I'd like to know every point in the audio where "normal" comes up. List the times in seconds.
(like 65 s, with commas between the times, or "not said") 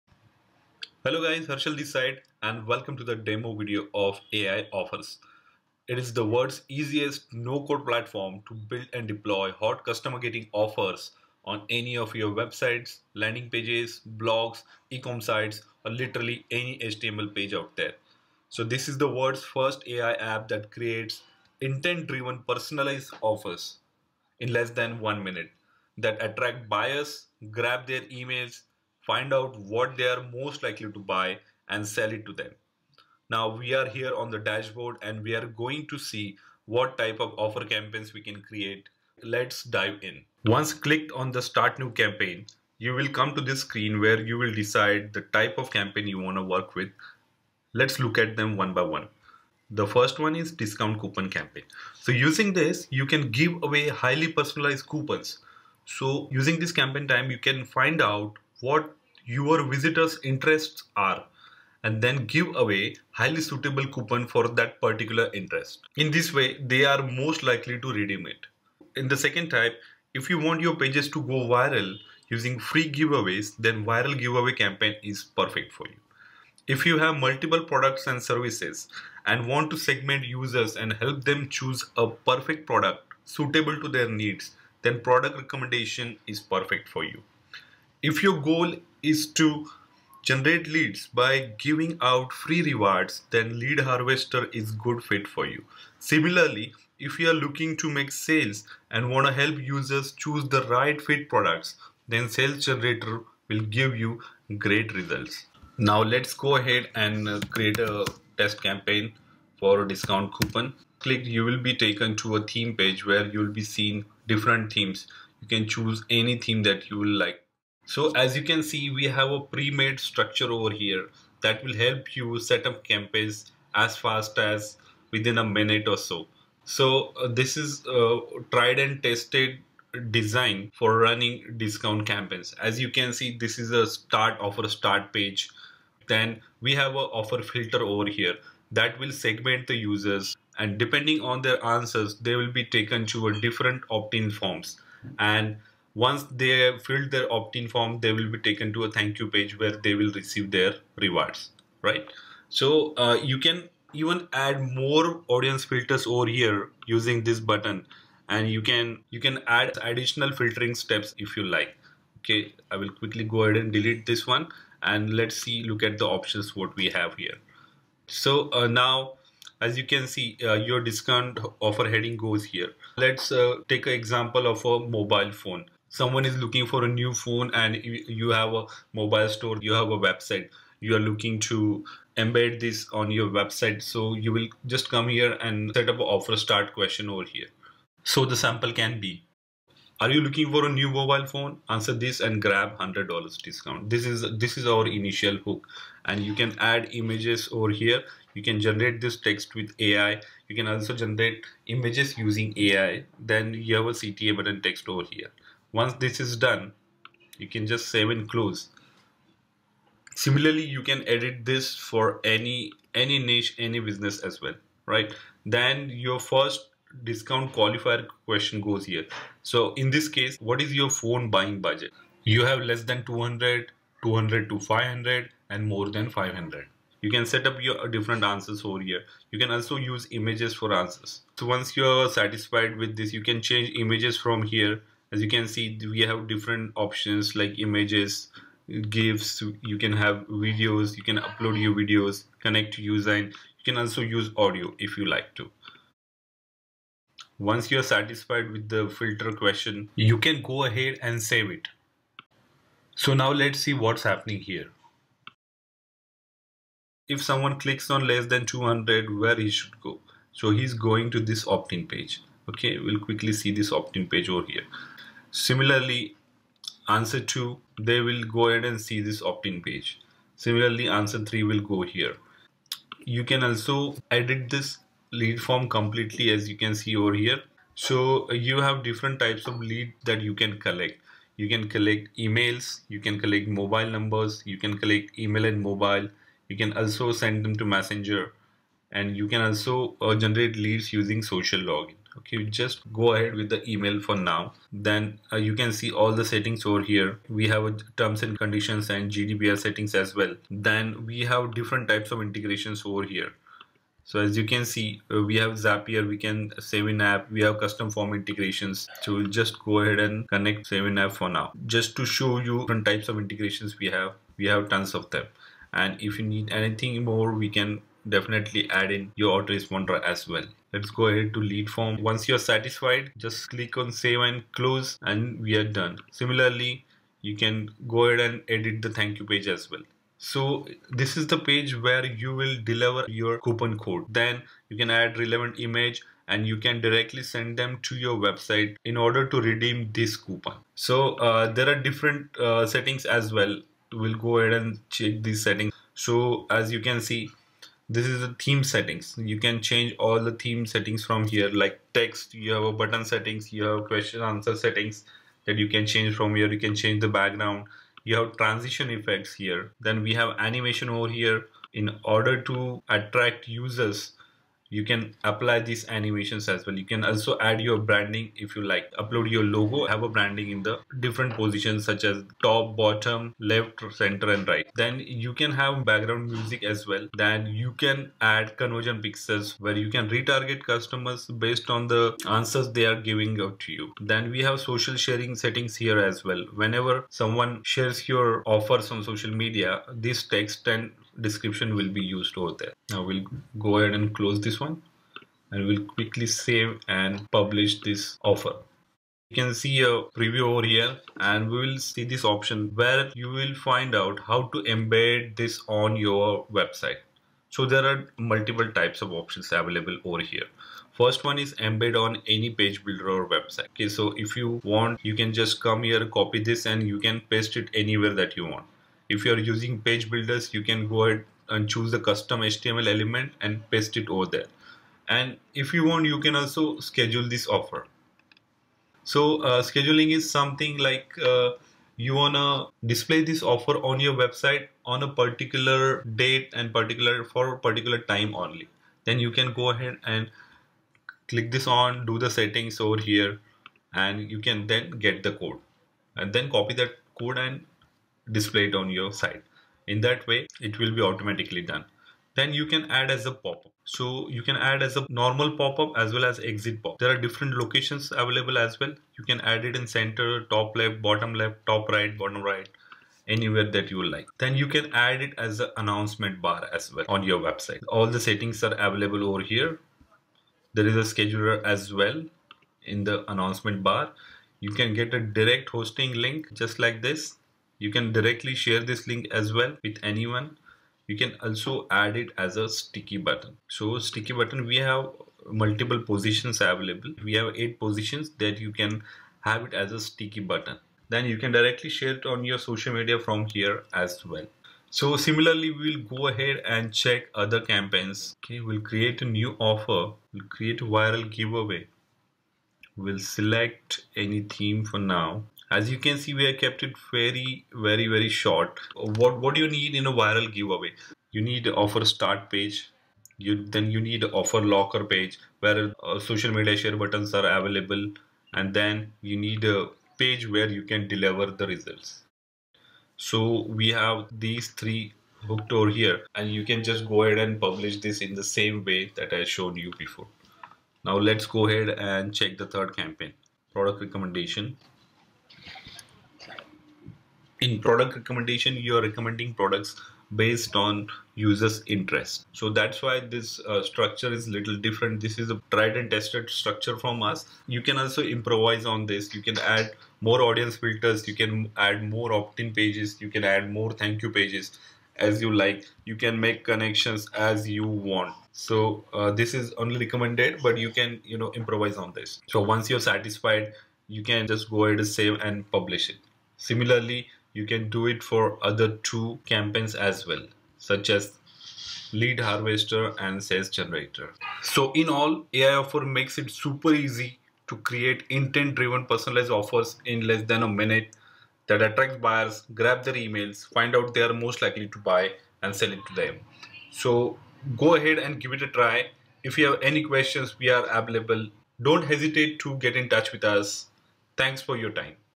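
455 s.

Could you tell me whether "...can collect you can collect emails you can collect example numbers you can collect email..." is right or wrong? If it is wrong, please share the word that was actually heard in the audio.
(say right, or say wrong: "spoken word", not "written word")
wrong: "mobile", not "example".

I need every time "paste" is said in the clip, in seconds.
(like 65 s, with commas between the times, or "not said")
417 s, 423 s.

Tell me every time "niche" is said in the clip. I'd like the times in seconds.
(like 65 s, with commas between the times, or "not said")
213 s.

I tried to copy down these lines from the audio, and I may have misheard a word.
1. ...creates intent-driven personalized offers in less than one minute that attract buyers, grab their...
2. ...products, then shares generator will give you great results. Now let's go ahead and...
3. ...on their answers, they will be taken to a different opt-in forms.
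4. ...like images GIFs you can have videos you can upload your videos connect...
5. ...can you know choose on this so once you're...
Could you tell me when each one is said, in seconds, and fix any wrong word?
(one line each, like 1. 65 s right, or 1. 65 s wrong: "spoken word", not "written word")
1. 20 s right
2. 101 s wrong: "sales", not "shares"
3. 141 s right
4. 237 s right
5. 560 s wrong: "improvise", not "choose".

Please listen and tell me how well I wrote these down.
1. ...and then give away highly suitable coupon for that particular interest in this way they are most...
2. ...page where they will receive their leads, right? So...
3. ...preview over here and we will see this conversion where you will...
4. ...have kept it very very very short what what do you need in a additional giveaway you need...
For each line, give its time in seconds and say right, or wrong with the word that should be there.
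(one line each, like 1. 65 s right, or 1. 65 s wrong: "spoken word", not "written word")
1. 61 s right
2. 149 s wrong: "rewards", not "leads"
3. 400 s wrong: "option", not "conversion"
4. 506 s wrong: "viral", not "additional".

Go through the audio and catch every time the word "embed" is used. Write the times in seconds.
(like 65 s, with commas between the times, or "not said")
182 s, 404 s, 411 s.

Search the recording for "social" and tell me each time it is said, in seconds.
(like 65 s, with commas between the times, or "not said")
291 s, 384 s, 389 s, 492 s, 516 s.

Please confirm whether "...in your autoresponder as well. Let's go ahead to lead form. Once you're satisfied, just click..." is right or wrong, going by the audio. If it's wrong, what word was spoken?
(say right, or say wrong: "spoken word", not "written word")
right.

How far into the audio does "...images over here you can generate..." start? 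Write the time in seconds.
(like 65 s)
197 s.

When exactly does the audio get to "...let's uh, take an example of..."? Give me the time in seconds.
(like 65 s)
172 s.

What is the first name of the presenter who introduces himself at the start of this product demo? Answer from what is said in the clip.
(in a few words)
Harshal.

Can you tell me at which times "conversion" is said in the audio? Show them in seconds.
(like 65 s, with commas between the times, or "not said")
378 s.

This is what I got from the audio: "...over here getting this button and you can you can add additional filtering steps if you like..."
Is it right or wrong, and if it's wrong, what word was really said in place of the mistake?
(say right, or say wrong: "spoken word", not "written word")
wrong: "using", not "getting".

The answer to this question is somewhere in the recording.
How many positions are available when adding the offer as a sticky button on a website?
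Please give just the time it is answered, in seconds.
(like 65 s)
487 s.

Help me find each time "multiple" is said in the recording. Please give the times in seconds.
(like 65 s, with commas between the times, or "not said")
77 s, 408 s, 485 s.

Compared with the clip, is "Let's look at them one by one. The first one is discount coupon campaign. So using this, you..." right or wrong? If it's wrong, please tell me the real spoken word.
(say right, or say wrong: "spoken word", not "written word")
right.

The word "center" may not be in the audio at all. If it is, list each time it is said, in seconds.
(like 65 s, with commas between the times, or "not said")
373 s, 459 s.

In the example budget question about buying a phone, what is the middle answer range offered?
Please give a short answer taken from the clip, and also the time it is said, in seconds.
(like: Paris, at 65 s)
200 to 500, at 224 s.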